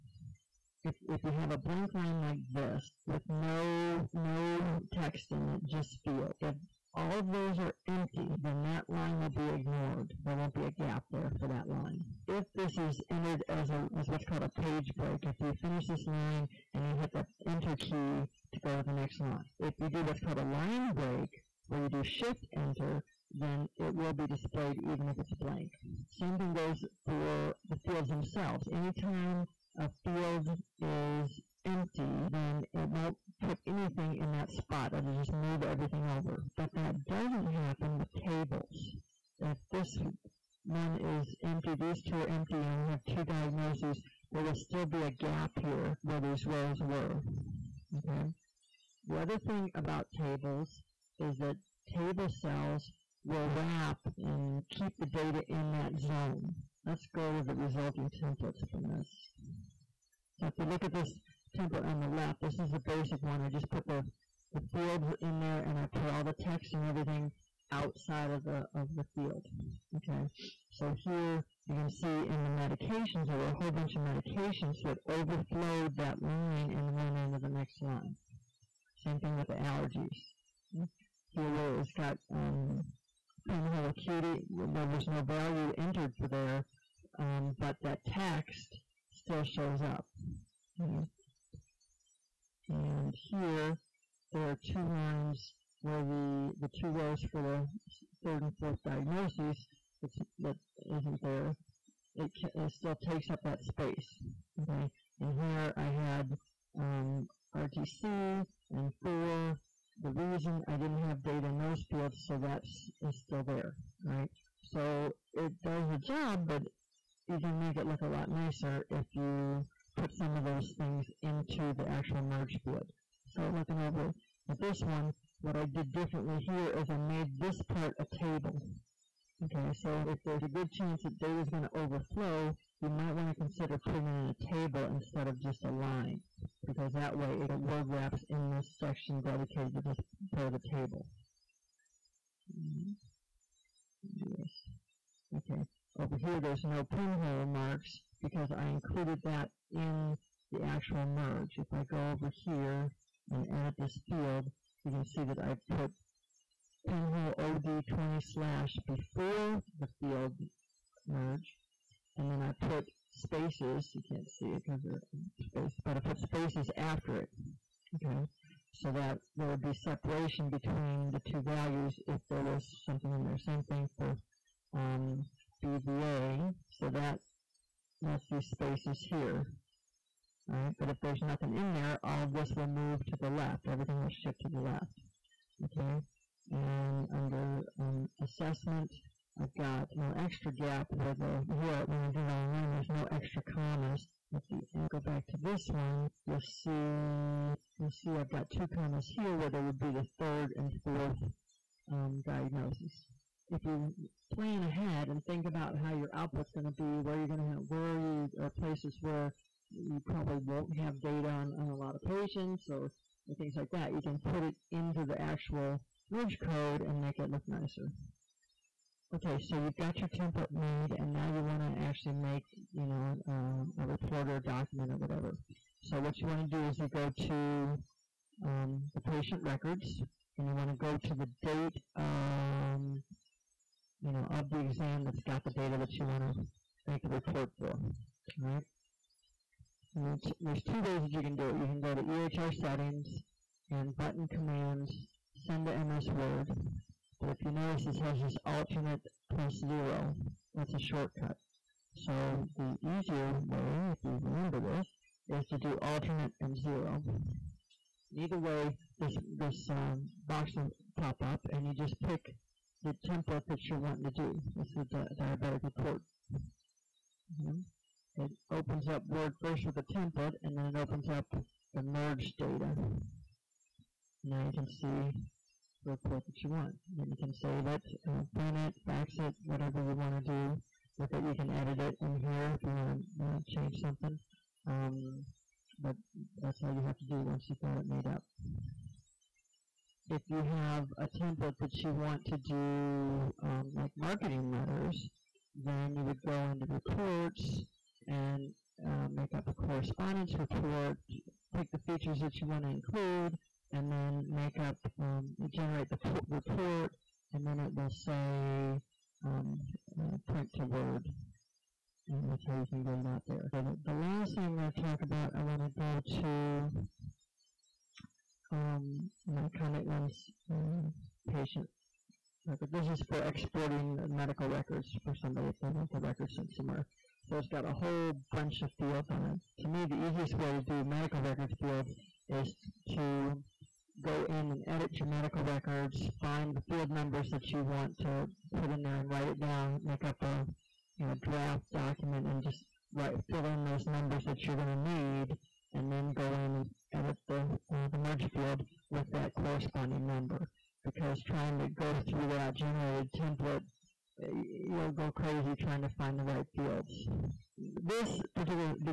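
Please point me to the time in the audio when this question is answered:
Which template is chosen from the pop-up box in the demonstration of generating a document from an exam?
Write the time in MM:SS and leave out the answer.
04:25.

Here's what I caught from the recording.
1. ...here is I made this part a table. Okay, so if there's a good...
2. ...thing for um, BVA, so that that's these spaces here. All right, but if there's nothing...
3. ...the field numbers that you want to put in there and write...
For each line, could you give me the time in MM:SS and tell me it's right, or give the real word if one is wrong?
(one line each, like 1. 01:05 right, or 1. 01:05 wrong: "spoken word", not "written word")
1. 02:06 right
2. 02:53 right
3. 05:36 right.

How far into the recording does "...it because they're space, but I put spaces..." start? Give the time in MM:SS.
02:44.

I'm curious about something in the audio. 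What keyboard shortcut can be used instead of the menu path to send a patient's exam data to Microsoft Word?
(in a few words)
Alt + 0.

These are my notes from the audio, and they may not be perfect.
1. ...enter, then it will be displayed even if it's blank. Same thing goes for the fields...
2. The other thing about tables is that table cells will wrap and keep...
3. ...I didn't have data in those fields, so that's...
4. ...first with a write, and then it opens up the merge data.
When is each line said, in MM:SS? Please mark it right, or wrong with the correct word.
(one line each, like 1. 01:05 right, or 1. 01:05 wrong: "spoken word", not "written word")
1. 00:22 right
2. 00:49 right
3. 01:50 right
4. 04:29 wrong: "template", not "write".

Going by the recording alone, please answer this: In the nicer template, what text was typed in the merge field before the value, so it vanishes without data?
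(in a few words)
pinhole OD20 slash.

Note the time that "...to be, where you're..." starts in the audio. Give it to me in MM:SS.
03:26.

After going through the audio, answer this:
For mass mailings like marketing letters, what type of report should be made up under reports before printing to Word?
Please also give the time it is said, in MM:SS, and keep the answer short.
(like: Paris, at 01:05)
Correspondence report, at 04:59.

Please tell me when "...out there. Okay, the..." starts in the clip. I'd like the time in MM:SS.
05:13.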